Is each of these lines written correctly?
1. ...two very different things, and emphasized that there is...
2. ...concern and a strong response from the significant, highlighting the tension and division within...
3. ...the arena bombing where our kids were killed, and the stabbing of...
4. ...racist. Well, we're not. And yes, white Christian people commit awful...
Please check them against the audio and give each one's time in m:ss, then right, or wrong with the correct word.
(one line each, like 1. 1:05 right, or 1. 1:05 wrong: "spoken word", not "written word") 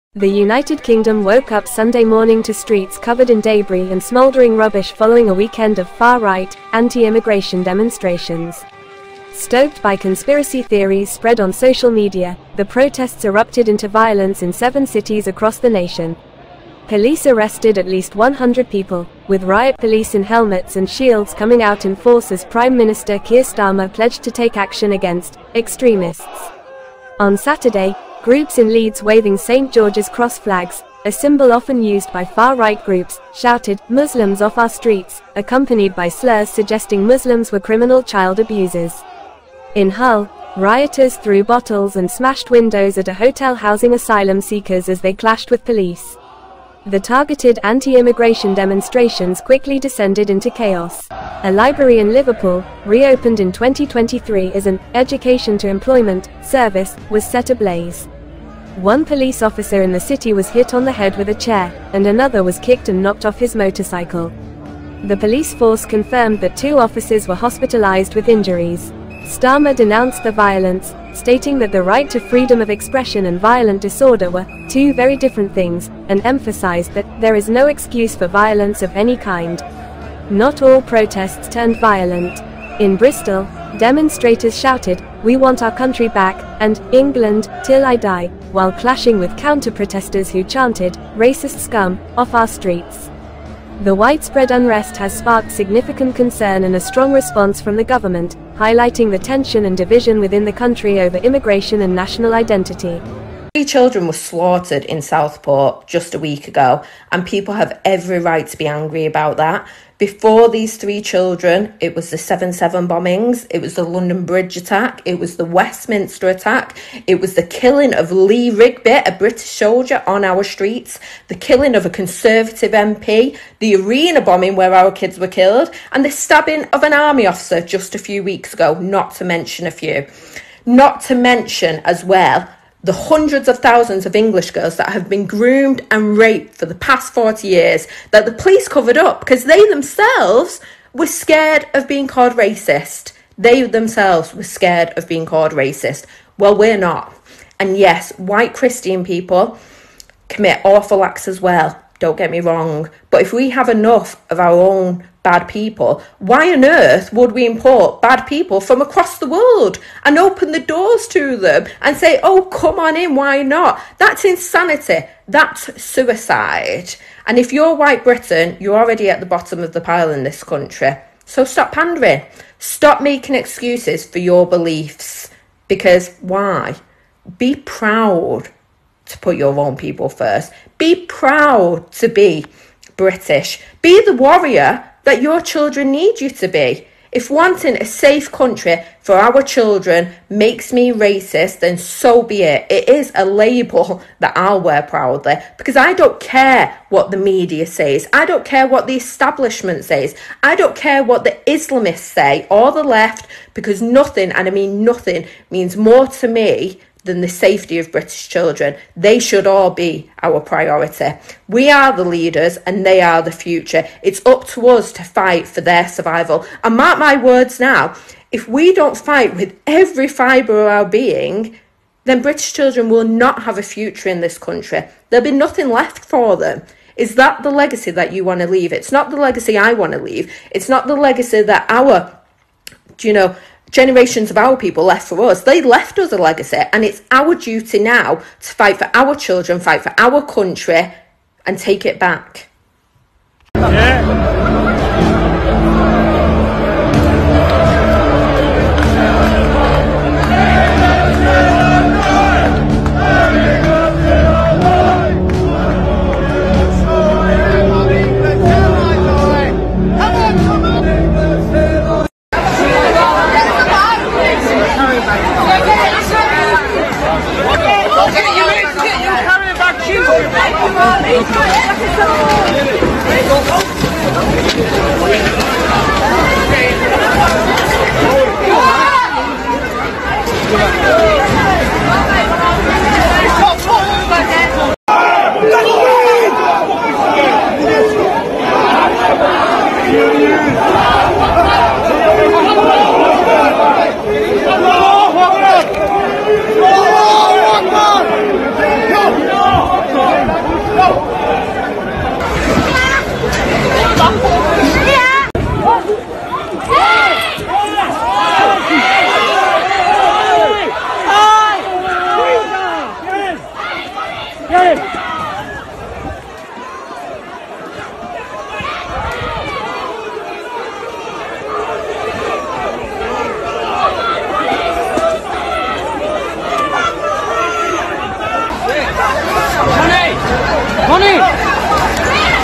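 1. 1:14 right
2. 1:36 wrong: "government", not "significant"
3. 2:03 right
4. 2:25 right.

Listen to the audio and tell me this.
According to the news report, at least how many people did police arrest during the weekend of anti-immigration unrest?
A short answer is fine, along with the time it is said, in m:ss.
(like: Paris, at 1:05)
100, at 0:18.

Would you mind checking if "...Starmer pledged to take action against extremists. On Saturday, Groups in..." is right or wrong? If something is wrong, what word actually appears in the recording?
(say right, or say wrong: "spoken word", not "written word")
right.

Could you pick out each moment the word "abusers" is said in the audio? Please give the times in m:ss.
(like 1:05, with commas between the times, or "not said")
0:38.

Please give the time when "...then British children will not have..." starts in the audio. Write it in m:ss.
3:42.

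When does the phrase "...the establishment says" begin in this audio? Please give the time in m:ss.
3:18.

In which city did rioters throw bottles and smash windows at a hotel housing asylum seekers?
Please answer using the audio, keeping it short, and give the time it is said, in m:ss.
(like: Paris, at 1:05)
Hull, at 0:39.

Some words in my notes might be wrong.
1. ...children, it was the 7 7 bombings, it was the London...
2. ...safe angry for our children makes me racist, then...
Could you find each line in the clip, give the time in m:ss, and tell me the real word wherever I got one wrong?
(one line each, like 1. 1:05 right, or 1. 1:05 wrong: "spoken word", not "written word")
1. 1:51 right
2. 3:07 wrong: "country", not "angry".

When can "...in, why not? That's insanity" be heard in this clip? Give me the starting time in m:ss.
2:42.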